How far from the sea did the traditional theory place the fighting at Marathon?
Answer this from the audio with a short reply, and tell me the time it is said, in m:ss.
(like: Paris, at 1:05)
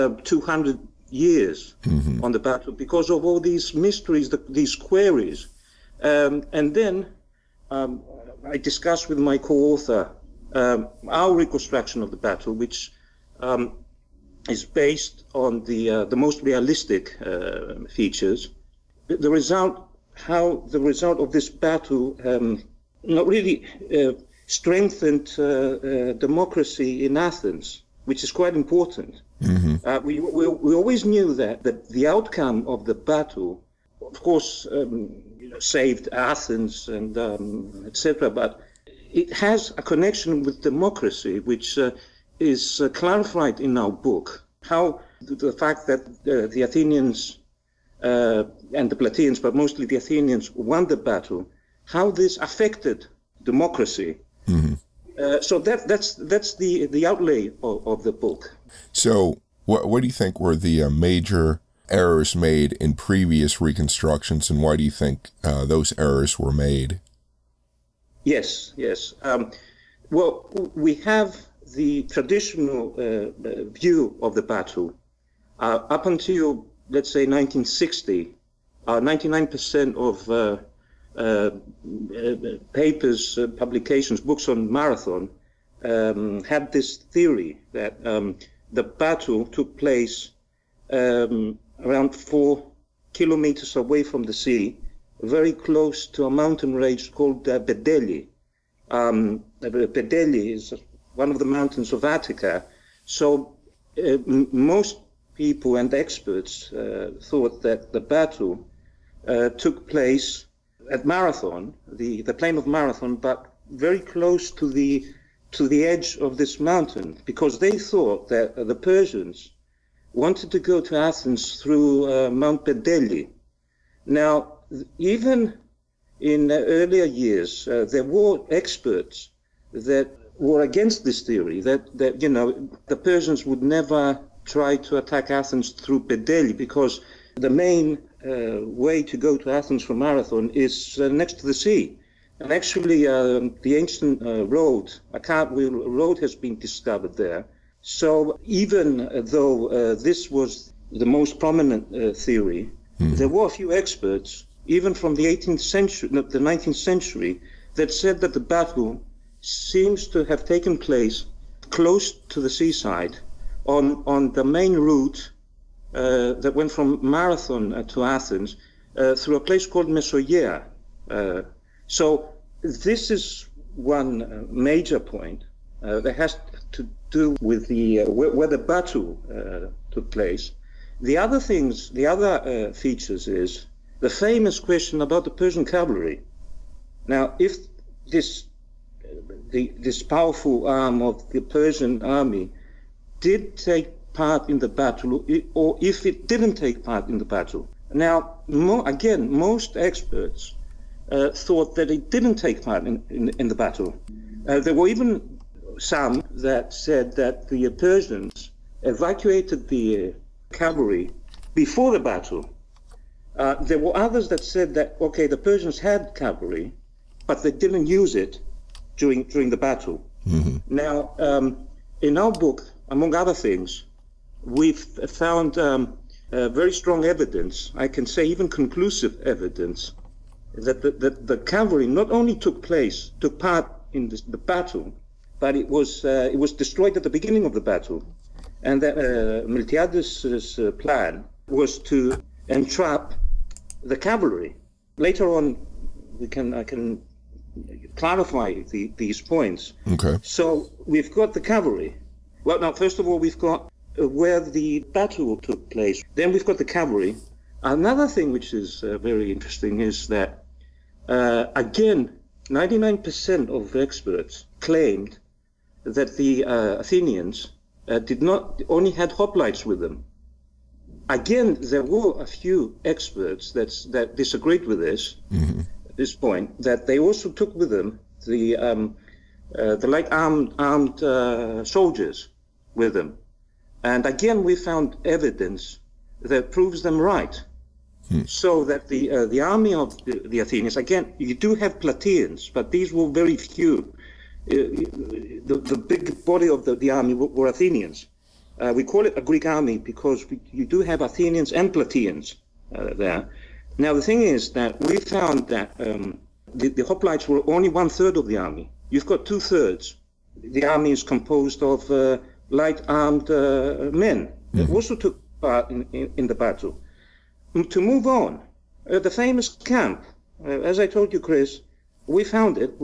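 4 kilometers, at 1:32.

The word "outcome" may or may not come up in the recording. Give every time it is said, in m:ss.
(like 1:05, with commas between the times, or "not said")
0:32.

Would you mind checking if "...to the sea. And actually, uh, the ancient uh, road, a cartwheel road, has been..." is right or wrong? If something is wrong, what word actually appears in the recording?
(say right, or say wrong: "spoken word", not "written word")
right.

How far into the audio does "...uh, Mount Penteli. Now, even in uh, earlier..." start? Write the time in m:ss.
2:02.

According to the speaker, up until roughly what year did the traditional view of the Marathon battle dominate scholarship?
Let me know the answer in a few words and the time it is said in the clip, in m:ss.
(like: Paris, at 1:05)
1960, at 1:17.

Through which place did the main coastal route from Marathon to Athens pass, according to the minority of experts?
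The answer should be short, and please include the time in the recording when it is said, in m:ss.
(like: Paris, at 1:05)
Mesogaea, at 2:49.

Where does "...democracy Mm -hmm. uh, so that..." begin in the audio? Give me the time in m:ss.
0:53.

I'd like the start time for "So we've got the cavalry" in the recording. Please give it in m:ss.
4:10.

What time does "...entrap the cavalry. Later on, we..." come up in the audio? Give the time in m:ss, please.
4:02.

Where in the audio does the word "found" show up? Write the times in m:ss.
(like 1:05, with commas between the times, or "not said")
3:45, 4:44, 5:04, 5:22.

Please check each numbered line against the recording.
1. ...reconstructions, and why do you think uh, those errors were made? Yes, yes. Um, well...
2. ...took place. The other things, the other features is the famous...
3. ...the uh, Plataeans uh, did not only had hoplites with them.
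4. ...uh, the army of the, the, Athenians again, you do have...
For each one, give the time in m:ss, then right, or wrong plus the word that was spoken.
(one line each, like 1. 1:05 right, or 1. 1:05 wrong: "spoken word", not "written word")
1. 1:03 right
2. 2:59 right
3. 4:26 wrong: "Athenians", not "Plataeans"
4. 4:49 right.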